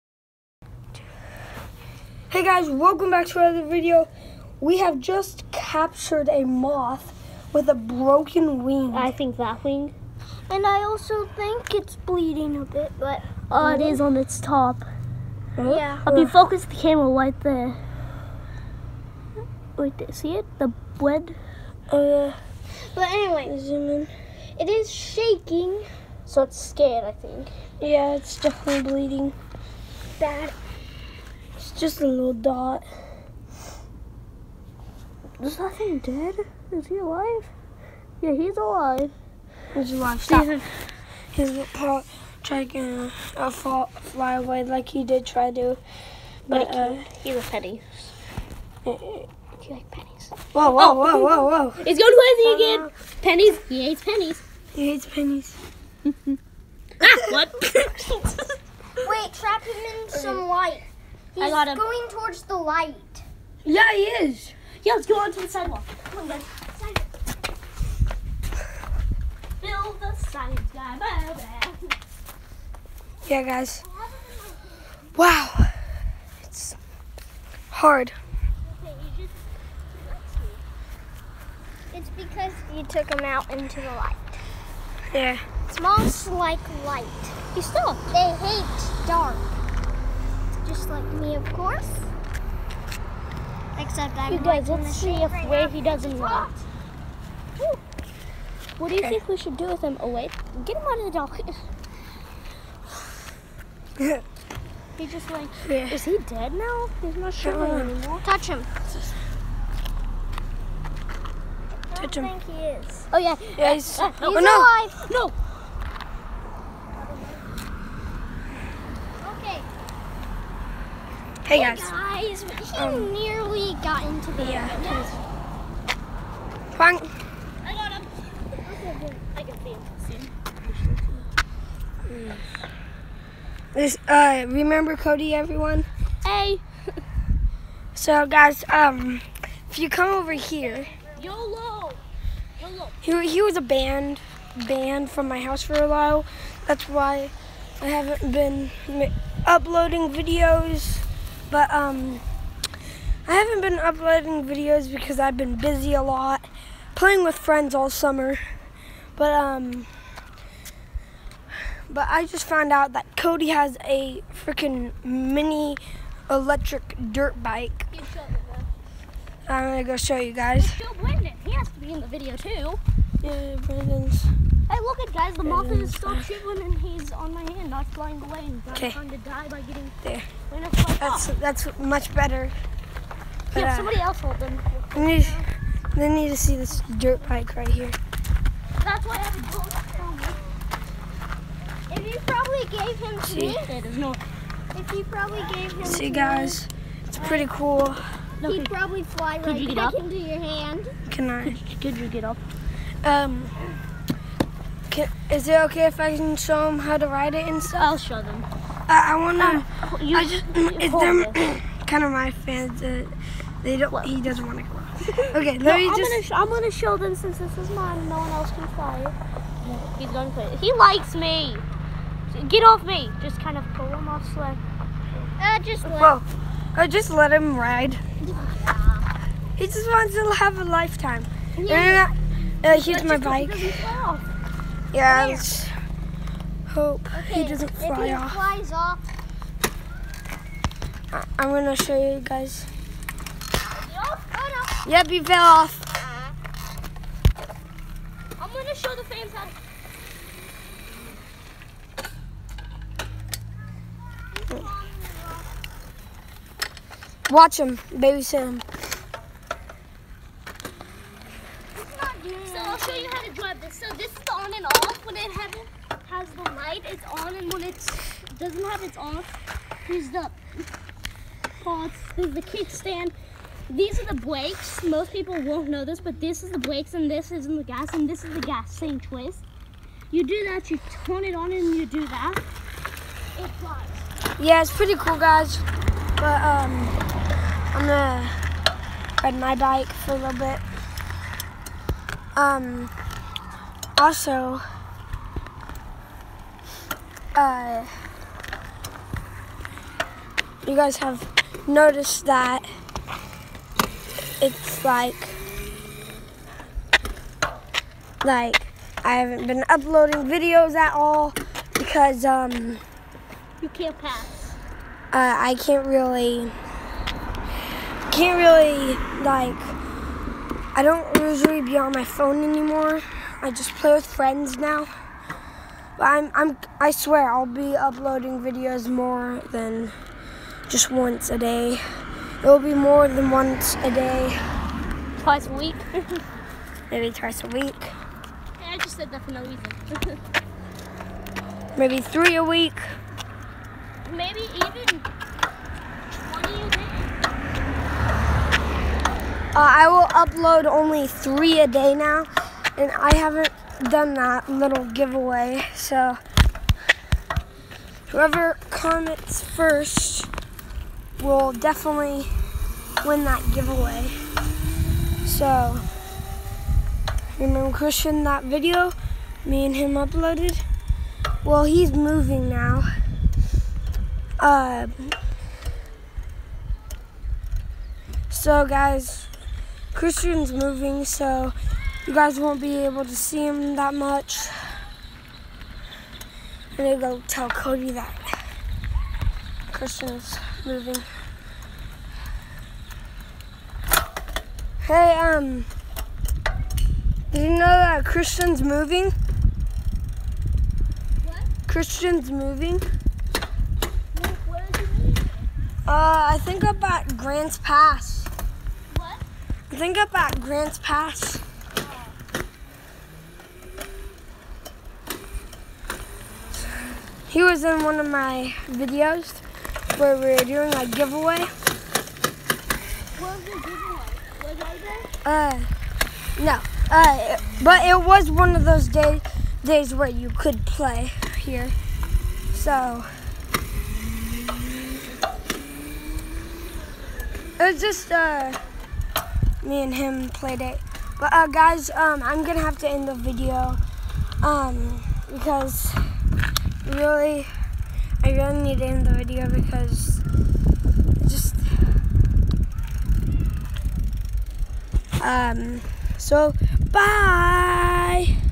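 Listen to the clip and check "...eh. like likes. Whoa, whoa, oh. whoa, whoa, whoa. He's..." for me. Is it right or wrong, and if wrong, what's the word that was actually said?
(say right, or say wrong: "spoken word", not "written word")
wrong: "pennies", not "likes".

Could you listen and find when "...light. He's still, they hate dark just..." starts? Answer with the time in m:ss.
1:26.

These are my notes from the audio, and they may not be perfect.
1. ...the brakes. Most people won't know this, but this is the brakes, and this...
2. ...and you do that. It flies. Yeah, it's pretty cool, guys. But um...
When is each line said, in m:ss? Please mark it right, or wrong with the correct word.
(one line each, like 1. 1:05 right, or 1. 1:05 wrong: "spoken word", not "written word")
1. 4:34 right
2. 4:41 right.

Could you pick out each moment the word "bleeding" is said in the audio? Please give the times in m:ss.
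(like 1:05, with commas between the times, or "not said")
0:11, 0:28.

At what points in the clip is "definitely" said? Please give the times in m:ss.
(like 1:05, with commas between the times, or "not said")
0:28, 6:01.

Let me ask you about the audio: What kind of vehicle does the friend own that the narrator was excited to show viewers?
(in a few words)
mini electric dirt bike.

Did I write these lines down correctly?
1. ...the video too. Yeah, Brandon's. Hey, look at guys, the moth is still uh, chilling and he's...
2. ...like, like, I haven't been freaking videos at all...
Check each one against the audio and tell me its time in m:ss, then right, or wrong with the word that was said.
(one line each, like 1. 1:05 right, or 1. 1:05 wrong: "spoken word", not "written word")
1. 2:51 right
2. 5:04 wrong: "uploading", not "freaking".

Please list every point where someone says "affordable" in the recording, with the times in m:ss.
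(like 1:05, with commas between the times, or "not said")
not said.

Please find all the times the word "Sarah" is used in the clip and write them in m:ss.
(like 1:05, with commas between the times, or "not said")
not said.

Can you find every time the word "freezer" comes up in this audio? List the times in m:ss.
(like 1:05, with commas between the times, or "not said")
not said.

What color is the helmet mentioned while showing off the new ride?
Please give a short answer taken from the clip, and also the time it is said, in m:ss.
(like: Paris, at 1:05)
gold, at 3:09.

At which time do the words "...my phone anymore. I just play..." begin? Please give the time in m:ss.
5:21.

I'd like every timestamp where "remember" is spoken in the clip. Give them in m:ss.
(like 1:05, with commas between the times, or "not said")
2:14, 6:07.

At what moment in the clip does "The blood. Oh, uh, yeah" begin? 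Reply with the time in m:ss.
0:20.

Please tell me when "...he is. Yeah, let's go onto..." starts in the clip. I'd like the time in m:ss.
1:03.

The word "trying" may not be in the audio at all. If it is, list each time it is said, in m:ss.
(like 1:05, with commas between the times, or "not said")
0:42, 2:58.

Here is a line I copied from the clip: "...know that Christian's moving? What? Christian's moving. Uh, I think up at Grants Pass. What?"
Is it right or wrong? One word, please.
right.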